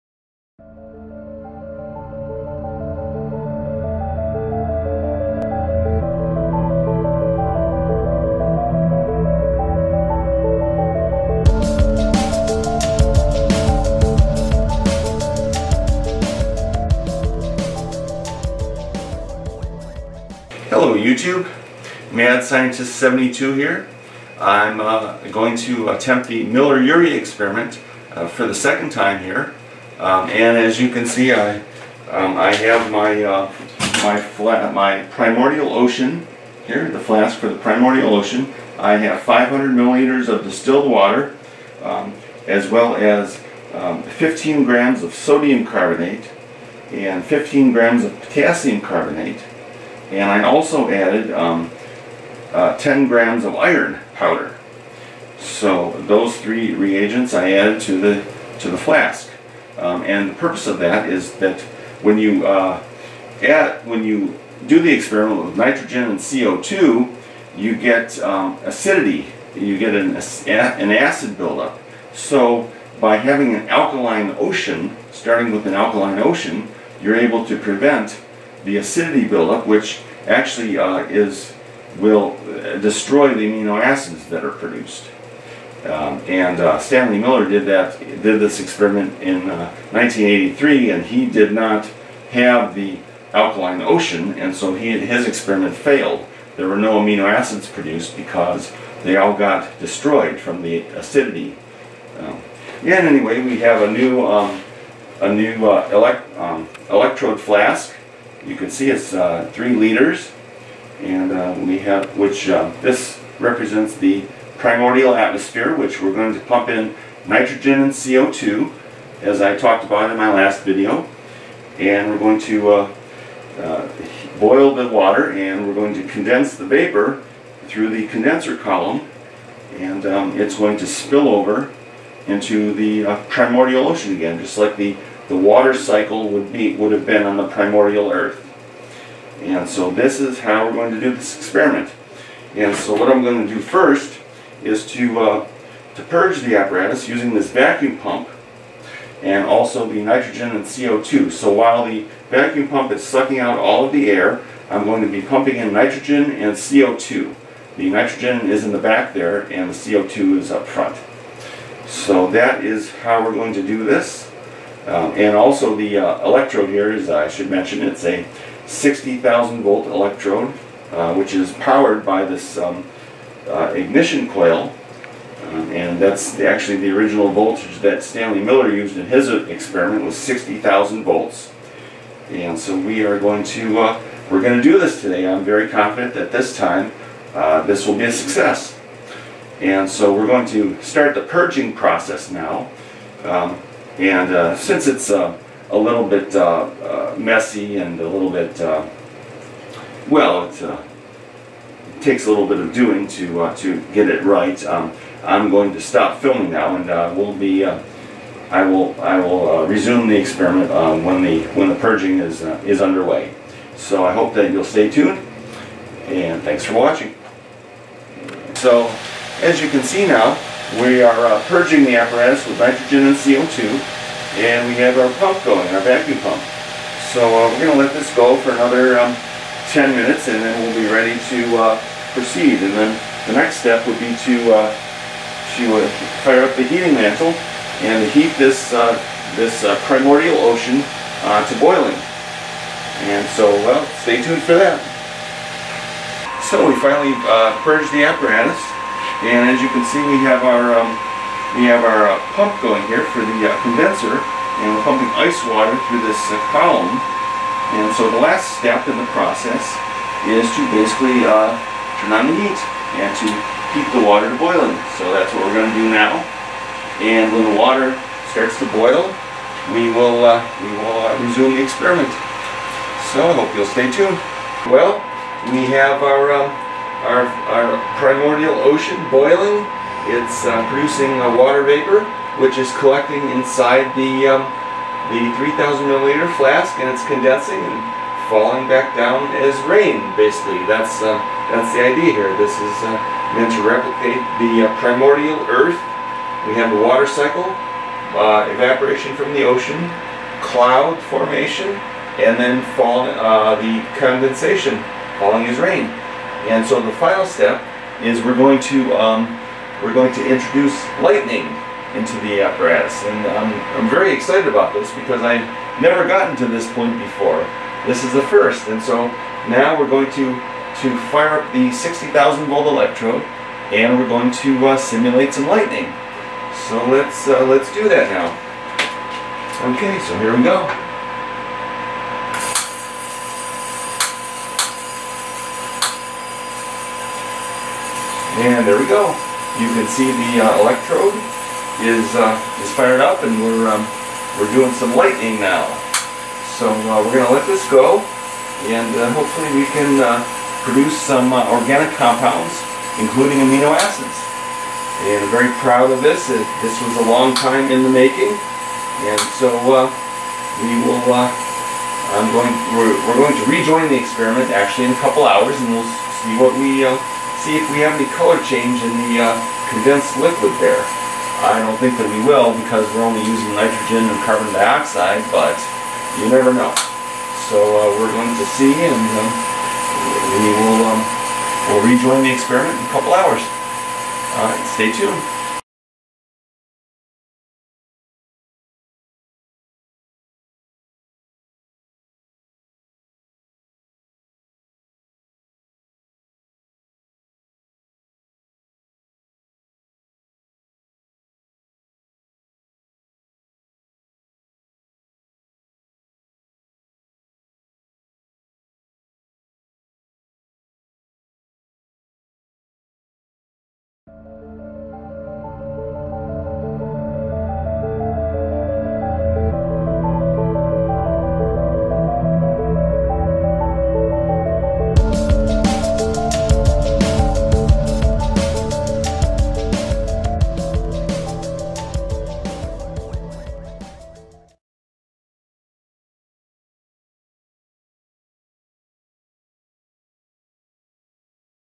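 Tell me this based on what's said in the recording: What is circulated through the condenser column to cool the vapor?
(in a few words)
ice water.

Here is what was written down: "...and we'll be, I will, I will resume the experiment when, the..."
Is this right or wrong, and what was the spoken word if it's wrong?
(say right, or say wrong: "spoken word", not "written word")
right.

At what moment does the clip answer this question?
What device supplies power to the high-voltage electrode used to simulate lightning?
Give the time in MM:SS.
02:53.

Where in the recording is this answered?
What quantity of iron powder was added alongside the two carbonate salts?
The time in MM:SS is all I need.
00:52.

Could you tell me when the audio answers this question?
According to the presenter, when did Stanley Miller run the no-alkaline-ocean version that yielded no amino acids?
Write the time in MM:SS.
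01:29.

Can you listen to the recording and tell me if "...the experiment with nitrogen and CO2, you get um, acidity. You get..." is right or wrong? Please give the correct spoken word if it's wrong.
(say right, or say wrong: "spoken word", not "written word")
right.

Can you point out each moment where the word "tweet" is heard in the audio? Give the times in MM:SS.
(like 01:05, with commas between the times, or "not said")
not said.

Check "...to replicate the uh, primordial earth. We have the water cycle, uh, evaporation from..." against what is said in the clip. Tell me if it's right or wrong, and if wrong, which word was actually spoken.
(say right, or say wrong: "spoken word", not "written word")
right.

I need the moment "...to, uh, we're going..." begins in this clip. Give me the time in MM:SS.
03:03.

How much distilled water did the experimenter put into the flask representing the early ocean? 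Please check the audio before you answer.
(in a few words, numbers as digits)
500 milliliters.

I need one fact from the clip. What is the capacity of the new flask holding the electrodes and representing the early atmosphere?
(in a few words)
3 liters.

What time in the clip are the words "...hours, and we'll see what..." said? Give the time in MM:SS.
06:05.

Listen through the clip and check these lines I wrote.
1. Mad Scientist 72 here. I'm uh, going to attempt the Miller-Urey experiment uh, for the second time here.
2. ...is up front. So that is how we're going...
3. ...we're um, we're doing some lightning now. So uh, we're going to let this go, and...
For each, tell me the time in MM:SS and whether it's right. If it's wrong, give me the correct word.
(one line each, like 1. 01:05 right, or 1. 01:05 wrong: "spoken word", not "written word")
1. 00:22 right
2. 02:40 right
3. 05:43 right.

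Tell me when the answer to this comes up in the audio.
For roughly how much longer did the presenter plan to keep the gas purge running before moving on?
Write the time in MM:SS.
03:49.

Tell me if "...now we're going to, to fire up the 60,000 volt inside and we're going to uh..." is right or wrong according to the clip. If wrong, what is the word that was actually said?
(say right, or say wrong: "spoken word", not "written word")
wrong: "electrode", not "inside".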